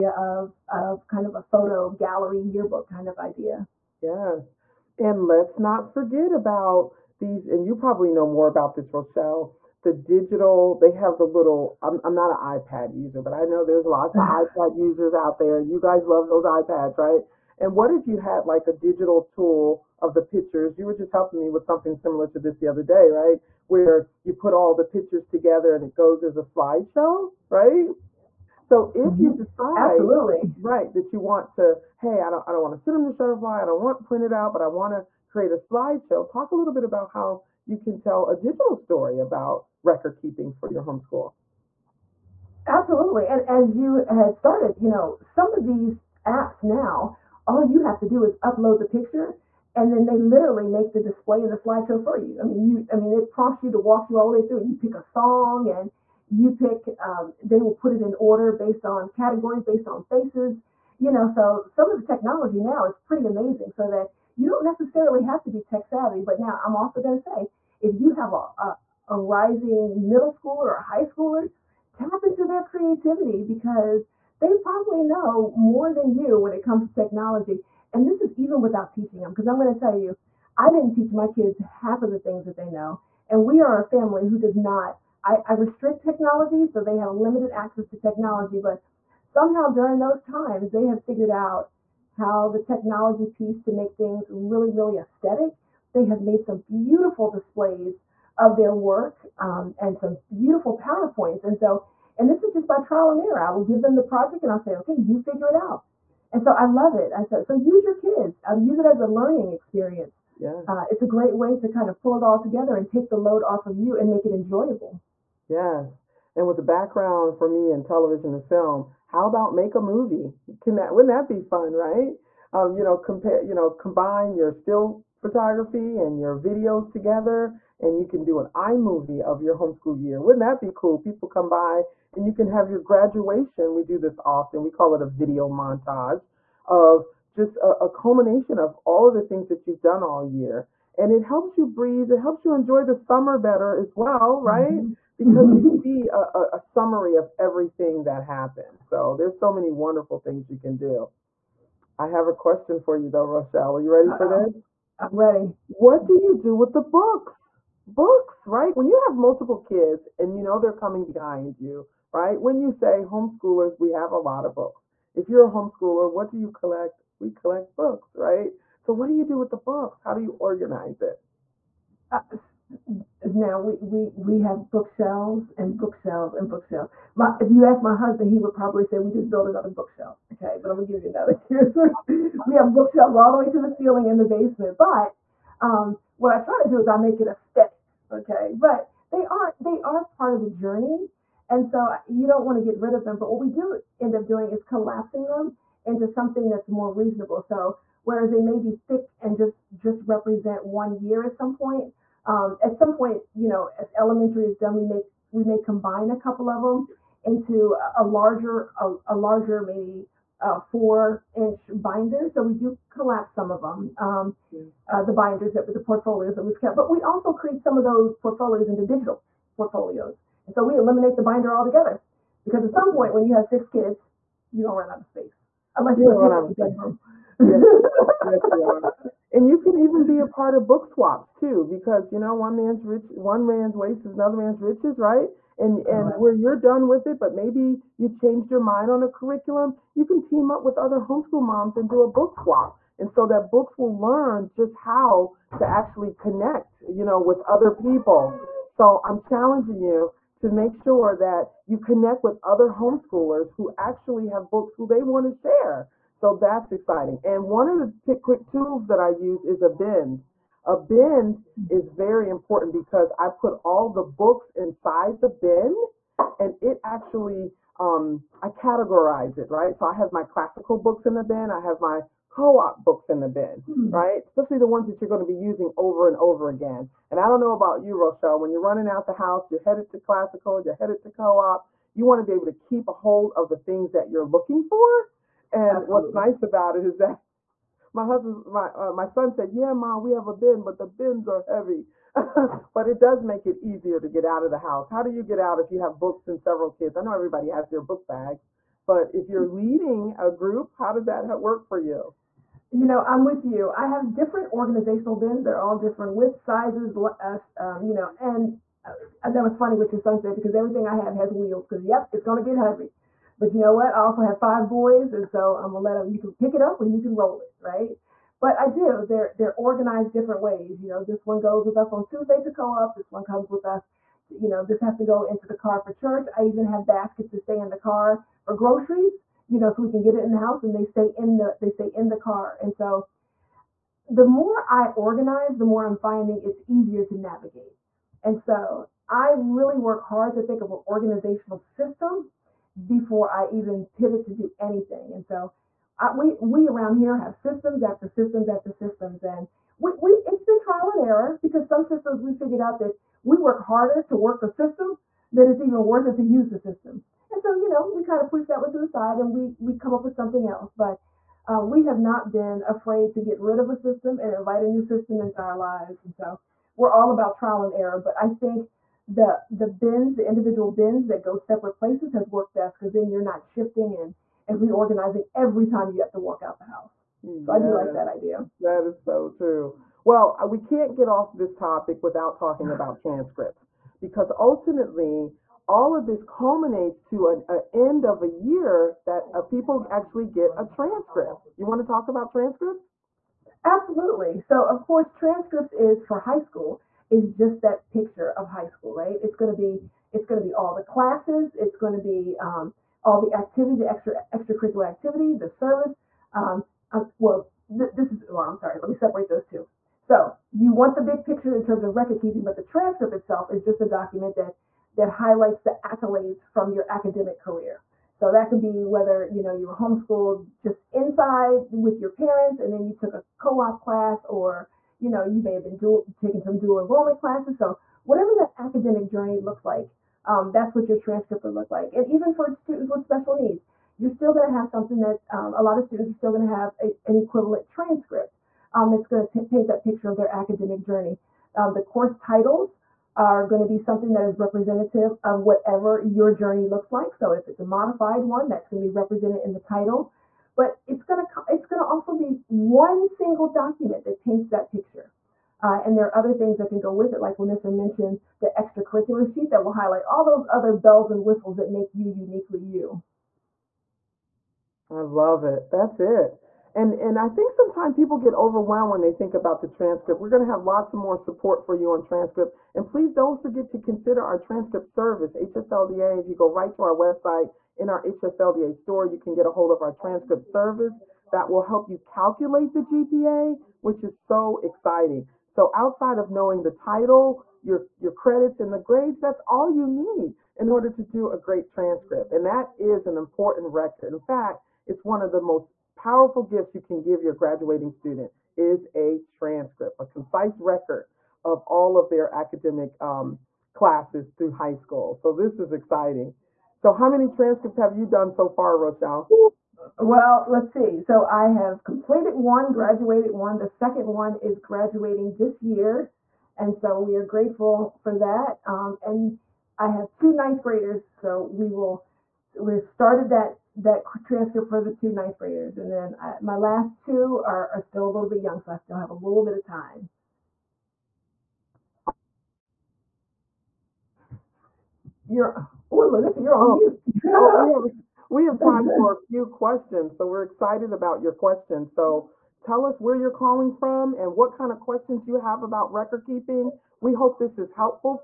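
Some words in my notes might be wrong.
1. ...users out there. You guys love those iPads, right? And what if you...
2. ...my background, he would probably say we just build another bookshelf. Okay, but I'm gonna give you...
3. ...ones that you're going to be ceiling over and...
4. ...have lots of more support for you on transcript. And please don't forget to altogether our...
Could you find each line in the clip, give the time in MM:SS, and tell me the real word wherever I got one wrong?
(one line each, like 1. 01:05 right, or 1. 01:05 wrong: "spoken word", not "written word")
1. 00:14 right
2. 02:57 wrong: "husband", not "background"
3. 04:34 wrong: "using", not "ceiling"
4. 07:50 wrong: "consider", not "altogether".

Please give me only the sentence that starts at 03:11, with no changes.
And so uh, you don't want to get rid of them.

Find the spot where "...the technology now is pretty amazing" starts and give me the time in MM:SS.
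01:01.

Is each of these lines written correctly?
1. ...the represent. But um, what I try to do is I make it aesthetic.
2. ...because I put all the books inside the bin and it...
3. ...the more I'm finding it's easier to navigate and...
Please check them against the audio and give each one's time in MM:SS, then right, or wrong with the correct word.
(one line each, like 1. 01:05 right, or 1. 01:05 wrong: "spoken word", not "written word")
1. 03:04 wrong: "basement", not "represent"
2. 04:22 right
3. 05:35 right.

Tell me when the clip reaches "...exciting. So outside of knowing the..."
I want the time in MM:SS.
08:04.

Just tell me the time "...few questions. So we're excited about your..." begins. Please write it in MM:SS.
08:59.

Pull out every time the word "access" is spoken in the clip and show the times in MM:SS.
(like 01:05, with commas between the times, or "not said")
01:27.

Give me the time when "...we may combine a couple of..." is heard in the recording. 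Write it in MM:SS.
03:25.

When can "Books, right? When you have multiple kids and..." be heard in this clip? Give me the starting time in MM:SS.
02:37.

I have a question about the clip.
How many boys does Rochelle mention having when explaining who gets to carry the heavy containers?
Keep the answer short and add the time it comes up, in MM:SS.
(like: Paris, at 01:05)
5, at 05:14.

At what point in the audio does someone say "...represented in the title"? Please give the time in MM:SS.
07:28.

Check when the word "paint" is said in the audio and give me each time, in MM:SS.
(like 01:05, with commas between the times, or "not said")
07:19, 07:34.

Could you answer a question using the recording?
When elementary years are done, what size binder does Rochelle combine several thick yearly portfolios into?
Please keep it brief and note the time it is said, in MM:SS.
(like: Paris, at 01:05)
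four inch, at 03:30.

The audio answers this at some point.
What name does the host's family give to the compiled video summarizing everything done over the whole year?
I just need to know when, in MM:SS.
02:15.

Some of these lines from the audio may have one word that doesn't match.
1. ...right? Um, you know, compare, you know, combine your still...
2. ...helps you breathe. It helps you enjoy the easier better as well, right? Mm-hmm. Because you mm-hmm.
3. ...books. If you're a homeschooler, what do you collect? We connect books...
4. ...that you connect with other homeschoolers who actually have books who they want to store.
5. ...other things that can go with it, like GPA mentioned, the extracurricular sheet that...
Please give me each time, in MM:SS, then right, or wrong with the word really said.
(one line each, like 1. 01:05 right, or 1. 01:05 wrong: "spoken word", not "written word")
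1. 02:01 right
2. 02:21 wrong: "summer", not "easier"
3. 02:44 wrong: "collect", not "connect"
4. 04:11 wrong: "share", not "store"
5. 07:36 wrong: "LaNissir", not "GPA".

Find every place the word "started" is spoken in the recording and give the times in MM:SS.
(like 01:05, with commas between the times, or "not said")
00:44, 08:42.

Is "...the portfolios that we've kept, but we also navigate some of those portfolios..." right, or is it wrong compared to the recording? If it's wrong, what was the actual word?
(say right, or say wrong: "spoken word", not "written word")
wrong: "create", not "navigate".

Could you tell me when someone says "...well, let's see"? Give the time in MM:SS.
08:30.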